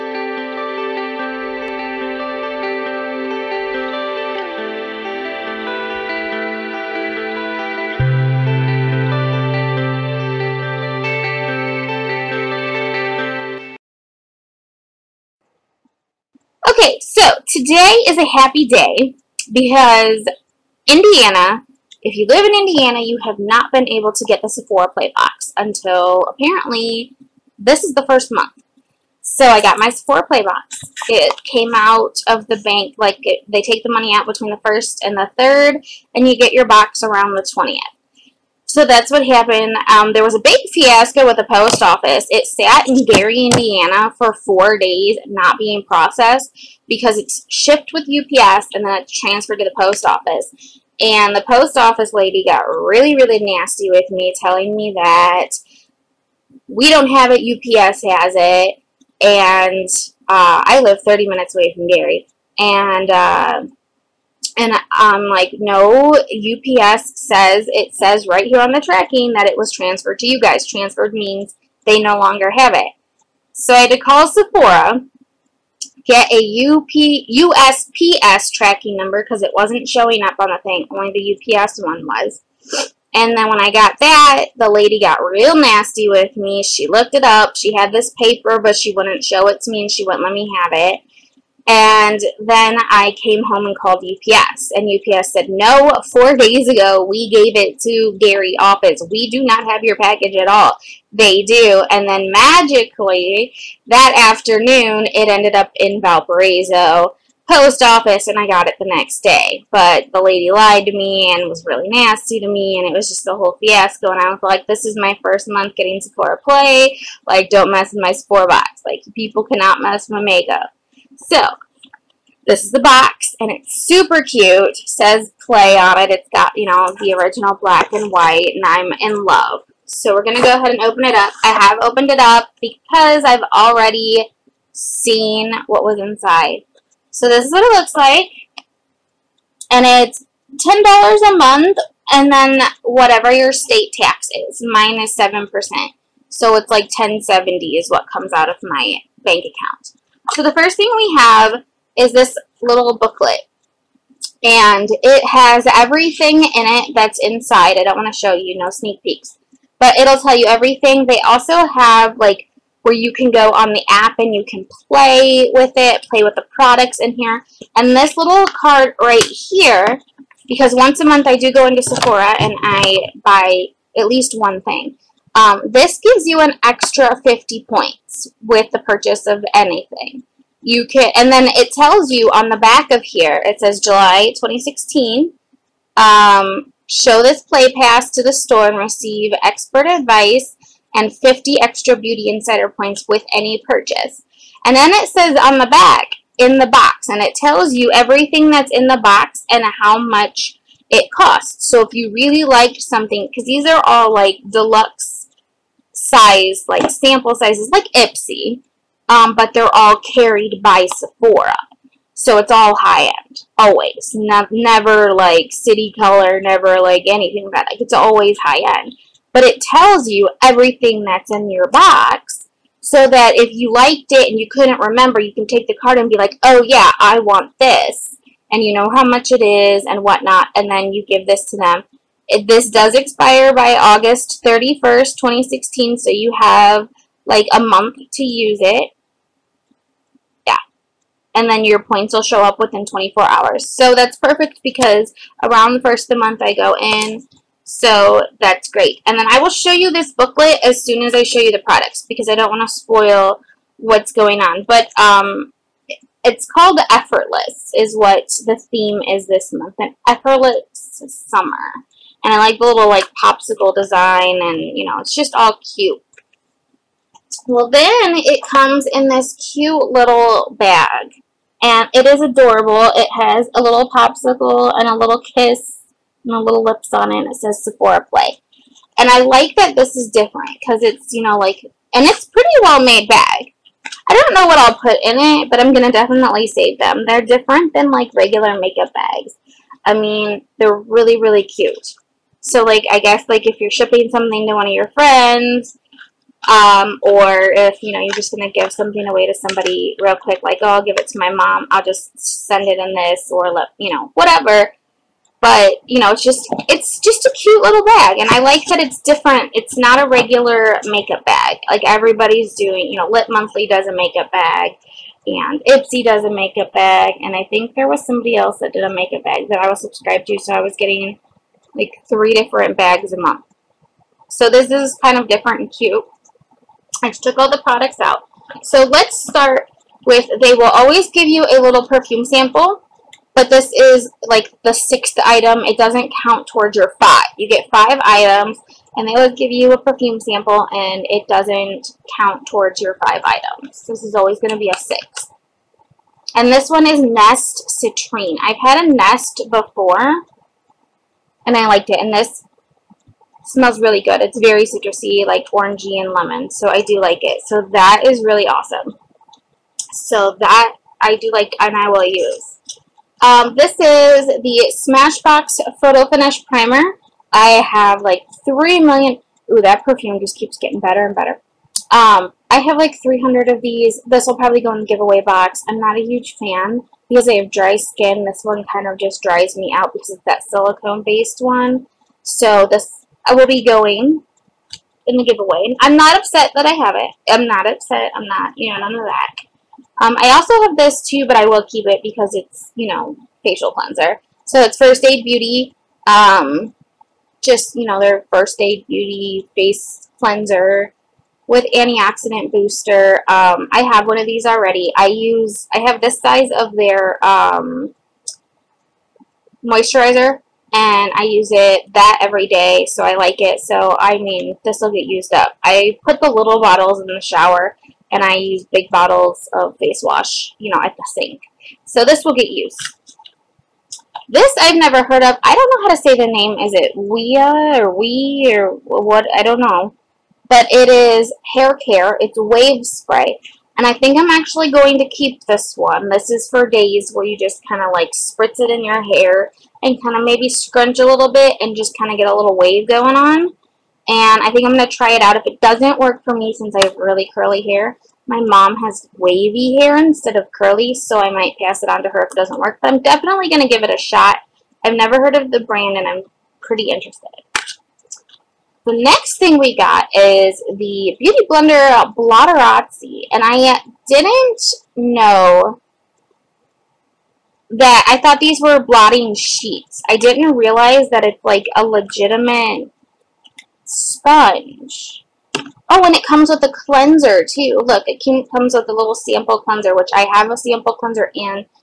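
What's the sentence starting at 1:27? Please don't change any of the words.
She had this paper, but she wouldn't show it to me and she wouldn't let me have it.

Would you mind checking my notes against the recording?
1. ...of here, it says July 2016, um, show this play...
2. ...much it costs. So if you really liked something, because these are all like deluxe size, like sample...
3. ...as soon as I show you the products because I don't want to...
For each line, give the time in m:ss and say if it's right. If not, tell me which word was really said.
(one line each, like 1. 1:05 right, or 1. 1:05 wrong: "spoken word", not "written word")
1. 3:02 right
2. 3:19 right
3. 4:10 right.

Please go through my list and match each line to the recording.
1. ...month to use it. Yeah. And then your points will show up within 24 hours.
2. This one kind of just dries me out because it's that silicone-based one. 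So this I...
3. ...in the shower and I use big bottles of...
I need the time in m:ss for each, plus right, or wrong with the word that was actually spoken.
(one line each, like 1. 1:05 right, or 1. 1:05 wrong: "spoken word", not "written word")
1. 3:57 right
2. 6:18 right
3. 6:57 right.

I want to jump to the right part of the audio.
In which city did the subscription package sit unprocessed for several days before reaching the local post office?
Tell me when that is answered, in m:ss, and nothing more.
0:43.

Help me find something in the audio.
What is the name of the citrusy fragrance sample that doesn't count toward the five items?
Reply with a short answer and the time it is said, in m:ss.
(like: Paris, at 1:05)
Nest Citrine, at 5:47.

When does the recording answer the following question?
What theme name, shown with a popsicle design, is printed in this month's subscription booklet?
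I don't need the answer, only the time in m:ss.
4:19.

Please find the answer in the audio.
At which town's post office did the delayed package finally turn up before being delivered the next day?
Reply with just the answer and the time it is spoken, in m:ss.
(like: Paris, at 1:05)
Valparaiso, at 1:46.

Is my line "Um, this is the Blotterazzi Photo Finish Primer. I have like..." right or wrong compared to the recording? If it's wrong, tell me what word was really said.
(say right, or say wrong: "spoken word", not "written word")
wrong: "Smashbox", not "Blotterazzi".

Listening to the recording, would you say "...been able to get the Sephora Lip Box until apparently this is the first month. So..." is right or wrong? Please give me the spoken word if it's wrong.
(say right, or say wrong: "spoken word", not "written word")
wrong: "Play", not "Lip".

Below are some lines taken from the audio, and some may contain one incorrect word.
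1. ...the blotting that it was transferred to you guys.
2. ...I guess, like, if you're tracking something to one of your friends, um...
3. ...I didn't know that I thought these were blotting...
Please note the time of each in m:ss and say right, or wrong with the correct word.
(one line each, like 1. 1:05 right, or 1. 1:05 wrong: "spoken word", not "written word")
1. 1:08 wrong: "tracking", not "blotting"
2. 4:52 wrong: "shipping", not "tracking"
3. 7:43 right.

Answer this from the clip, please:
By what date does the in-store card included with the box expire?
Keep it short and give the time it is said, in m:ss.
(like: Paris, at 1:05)
August 31st, 2016, at 3:53.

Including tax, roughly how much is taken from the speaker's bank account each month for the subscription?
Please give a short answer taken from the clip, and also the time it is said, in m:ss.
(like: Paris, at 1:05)
$10.70, at 2:26.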